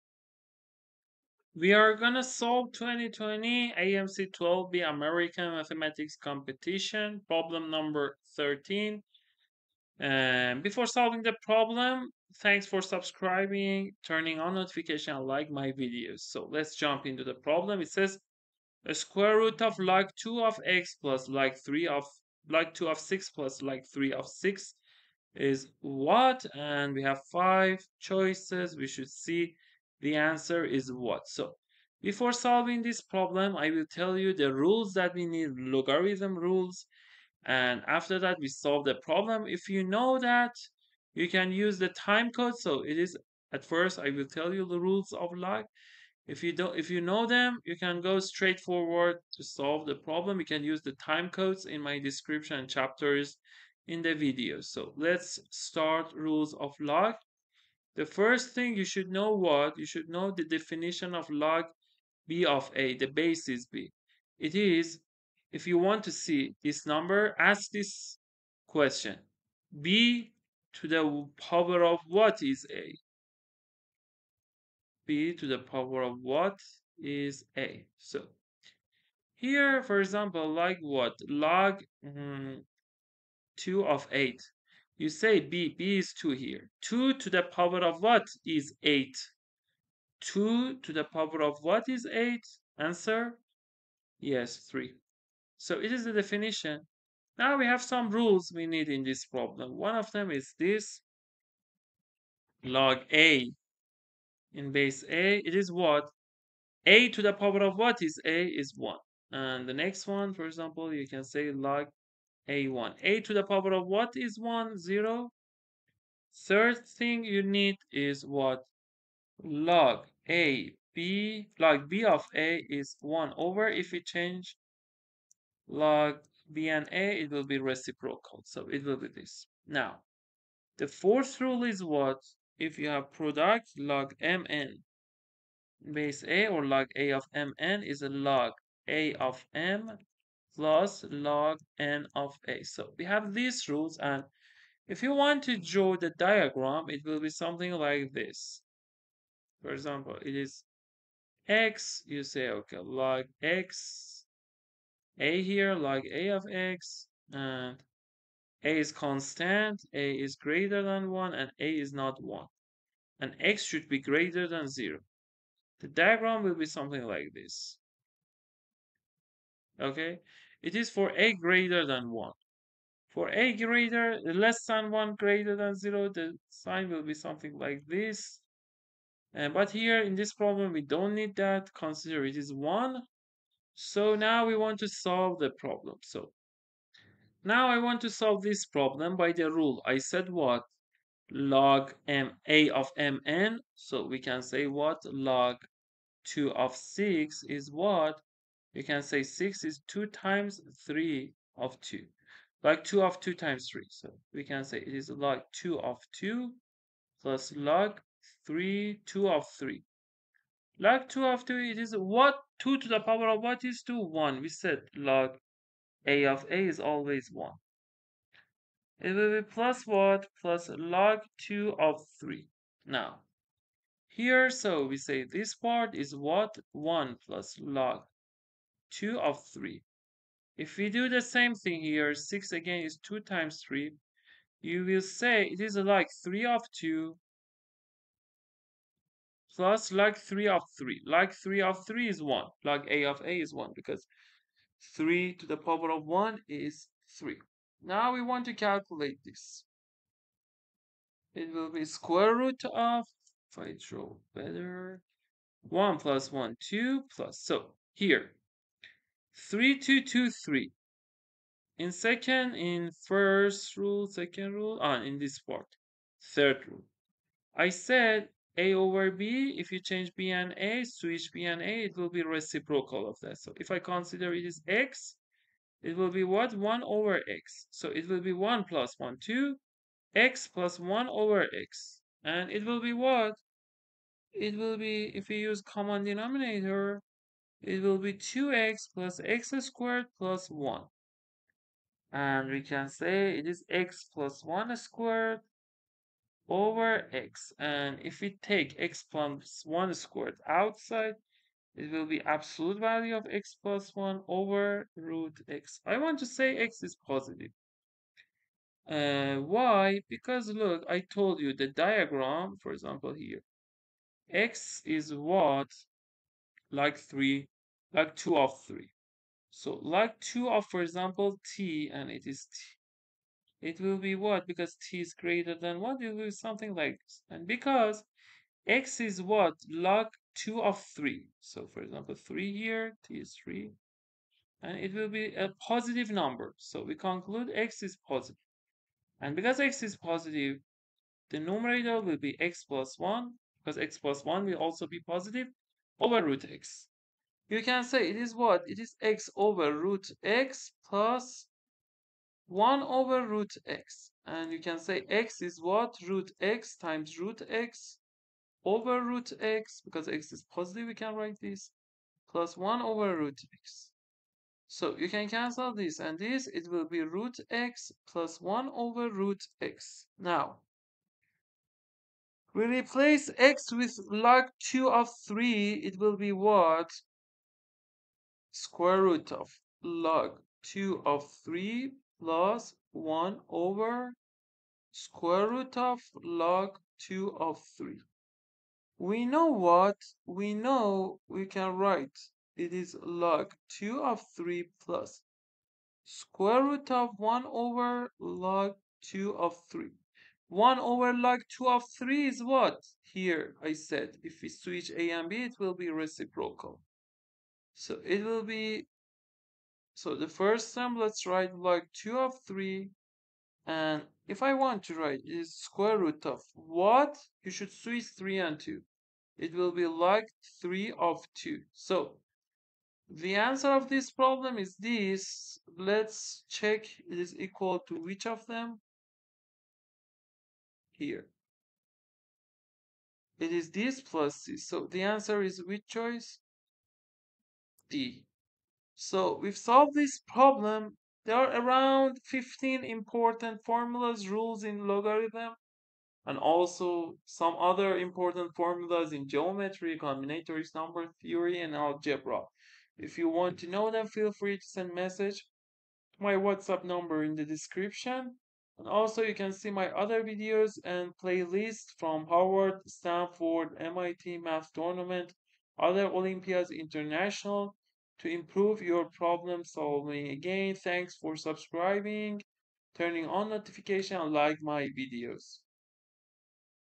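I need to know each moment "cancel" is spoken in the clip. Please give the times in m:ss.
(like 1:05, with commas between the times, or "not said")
6:05.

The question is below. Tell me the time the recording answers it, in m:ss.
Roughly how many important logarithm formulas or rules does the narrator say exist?
7:22.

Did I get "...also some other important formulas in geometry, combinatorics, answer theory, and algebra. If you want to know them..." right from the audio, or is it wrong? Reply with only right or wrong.
wrong.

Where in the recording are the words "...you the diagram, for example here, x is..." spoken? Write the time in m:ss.
5:11.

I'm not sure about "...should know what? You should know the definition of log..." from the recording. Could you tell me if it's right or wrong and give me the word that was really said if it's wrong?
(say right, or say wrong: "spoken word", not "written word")
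right.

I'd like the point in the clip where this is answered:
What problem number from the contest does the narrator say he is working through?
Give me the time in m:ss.
0:08.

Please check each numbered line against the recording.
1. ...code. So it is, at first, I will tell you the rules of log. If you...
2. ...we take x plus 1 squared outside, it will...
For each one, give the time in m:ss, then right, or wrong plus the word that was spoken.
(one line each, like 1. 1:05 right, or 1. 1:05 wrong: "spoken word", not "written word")
1. 0:42 right
2. 4:58 right.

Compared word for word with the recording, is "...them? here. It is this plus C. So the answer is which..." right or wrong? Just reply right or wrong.
right.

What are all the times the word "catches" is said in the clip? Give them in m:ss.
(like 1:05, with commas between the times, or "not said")
not said.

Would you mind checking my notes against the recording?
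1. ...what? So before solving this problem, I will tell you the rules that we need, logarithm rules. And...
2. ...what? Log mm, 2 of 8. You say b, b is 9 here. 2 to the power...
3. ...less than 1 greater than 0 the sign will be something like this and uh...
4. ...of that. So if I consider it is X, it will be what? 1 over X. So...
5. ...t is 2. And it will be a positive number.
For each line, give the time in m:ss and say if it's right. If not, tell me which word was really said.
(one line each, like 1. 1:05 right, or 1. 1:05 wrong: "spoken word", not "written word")
1. 0:30 right
2. 1:20 wrong: "2", not "9"
3. 2:54 right
4. 4:33 right
5. 5:33 wrong: "3", not "2".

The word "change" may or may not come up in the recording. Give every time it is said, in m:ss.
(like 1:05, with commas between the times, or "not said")
2:04, 4:29.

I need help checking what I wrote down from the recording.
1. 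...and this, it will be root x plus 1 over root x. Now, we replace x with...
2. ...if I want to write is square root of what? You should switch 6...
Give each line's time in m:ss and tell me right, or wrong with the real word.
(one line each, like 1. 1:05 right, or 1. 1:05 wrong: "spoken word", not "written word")
1. 6:05 right
2. 6:54 wrong: "3", not "6".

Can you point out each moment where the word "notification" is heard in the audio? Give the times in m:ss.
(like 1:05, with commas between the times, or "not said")
0:14, 7:53.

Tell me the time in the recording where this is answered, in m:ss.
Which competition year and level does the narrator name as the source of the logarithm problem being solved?
0:02.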